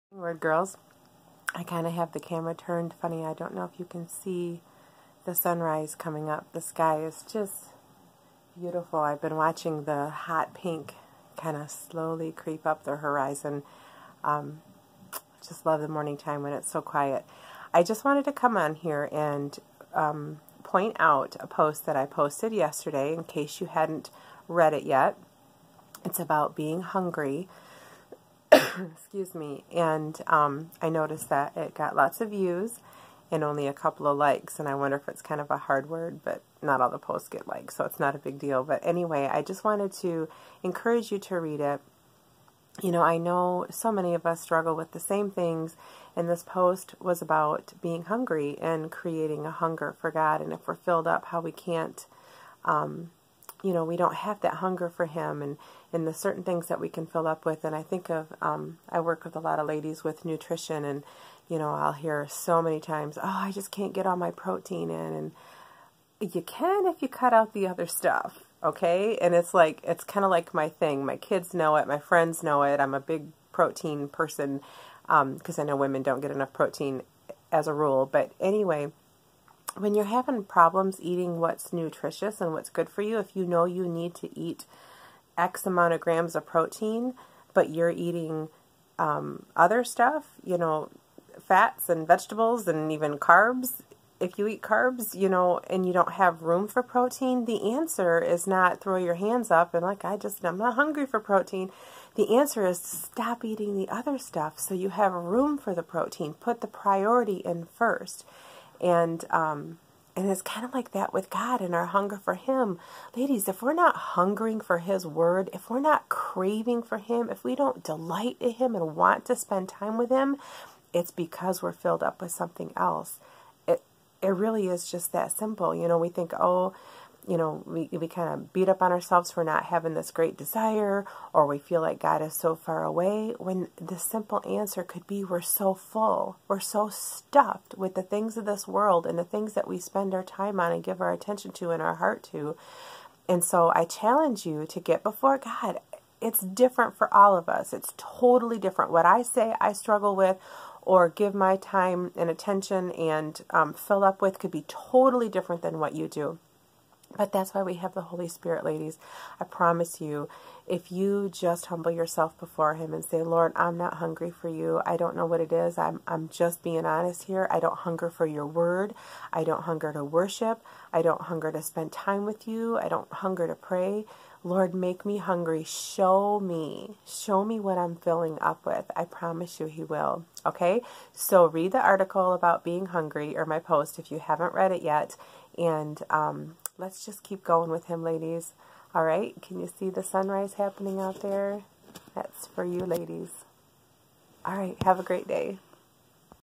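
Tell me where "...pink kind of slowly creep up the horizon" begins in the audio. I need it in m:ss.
0:10.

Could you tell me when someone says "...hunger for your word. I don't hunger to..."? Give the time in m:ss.
2:47.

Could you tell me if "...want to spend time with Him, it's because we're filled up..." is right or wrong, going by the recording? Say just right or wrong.
right.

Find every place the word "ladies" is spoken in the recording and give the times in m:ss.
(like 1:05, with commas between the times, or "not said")
0:59, 1:53, 2:38, 3:08, 3:12.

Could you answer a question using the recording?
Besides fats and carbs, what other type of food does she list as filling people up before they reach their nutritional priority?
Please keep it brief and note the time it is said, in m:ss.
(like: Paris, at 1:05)
Vegetables, at 1:32.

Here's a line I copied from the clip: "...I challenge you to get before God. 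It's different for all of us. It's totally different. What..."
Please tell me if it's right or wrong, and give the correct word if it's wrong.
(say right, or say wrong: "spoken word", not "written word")
right.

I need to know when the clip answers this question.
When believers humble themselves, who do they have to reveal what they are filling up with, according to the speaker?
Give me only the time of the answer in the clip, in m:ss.
2:37.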